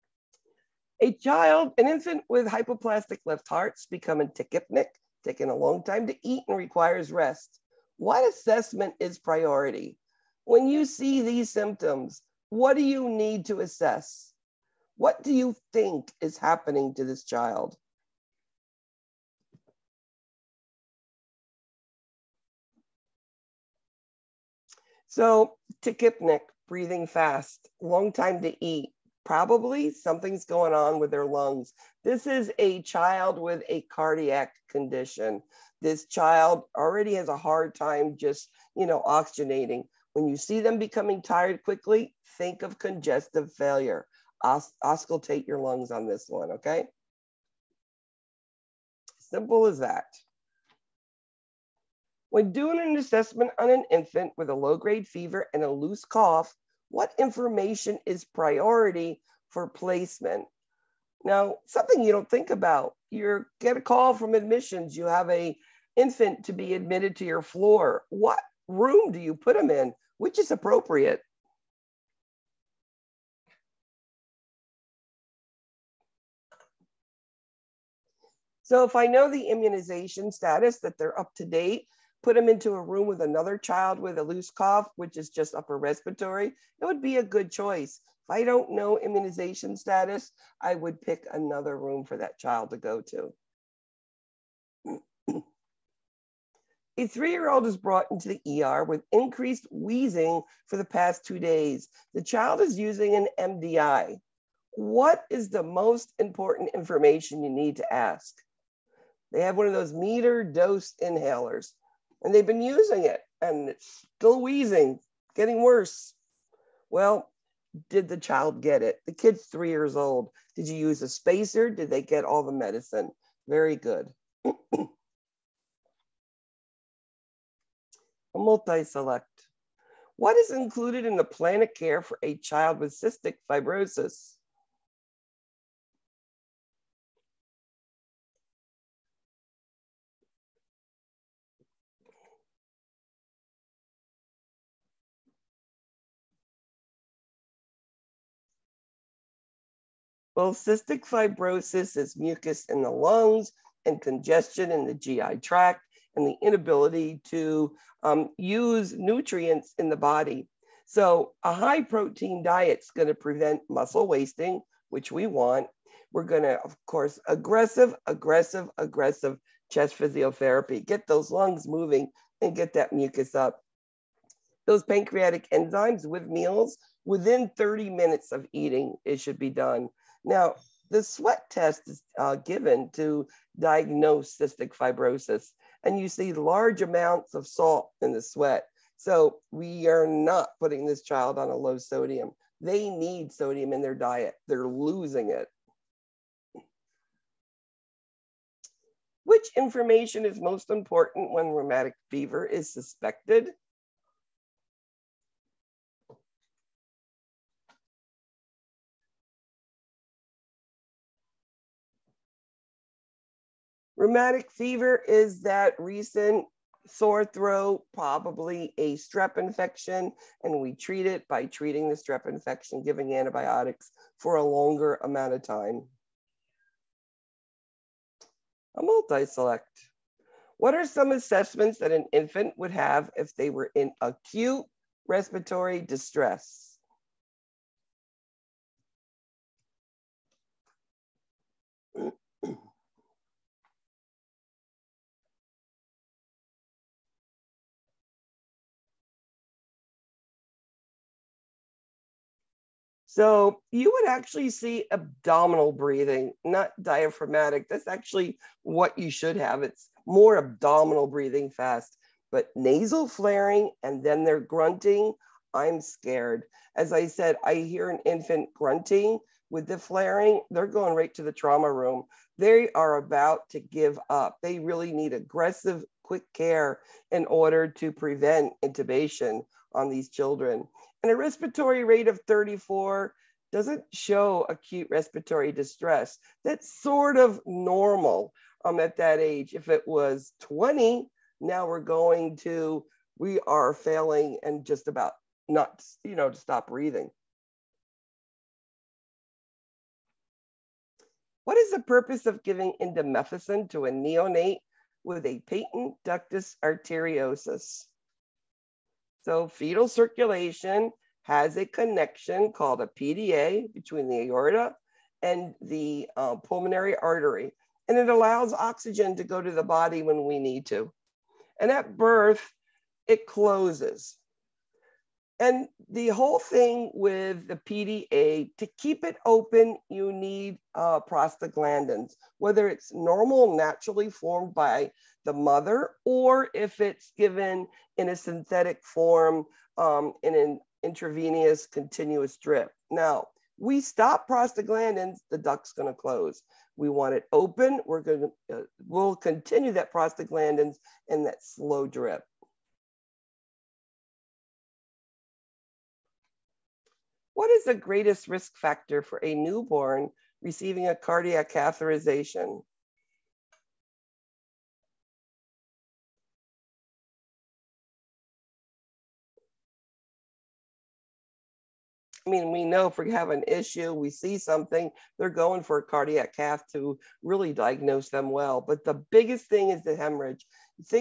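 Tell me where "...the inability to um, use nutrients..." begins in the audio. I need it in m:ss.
2:36.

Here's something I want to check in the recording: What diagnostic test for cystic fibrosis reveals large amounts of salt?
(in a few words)
Sweat test.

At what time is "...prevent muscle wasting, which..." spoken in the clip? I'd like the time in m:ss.
2:43.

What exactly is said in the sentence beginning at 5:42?
Now, we stop prostaglandins, the duct's gonna close.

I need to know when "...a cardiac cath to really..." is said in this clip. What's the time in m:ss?
6:15.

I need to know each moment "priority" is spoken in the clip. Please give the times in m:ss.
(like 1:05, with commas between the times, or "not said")
0:09, 0:58.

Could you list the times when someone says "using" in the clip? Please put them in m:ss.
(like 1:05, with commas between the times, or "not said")
1:42, 1:52.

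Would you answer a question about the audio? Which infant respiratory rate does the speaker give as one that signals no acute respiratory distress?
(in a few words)
34.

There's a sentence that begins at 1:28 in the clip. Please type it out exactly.
If I don't know immunization status, I would pick another room for that child to go to.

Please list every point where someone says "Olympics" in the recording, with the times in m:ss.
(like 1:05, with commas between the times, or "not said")
not said.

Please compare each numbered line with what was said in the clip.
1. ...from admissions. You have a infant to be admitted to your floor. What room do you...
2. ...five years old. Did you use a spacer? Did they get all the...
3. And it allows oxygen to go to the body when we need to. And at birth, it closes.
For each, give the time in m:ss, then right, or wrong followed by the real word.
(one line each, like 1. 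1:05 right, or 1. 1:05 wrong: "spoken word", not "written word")
1. 1:04 right
2. 1:59 wrong: "three", not "five"
3. 5:17 right.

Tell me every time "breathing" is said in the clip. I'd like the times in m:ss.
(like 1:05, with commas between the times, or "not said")
0:26, 4:15, 4:21, 4:56.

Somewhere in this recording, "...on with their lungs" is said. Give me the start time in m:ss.
0:30.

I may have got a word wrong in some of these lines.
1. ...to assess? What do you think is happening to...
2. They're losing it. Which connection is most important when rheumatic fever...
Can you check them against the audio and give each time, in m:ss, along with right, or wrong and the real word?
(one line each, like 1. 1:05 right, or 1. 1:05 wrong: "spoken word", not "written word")
1. 0:13 right
2. 3:14 wrong: "information", not "connection".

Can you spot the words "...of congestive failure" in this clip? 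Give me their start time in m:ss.
0:42.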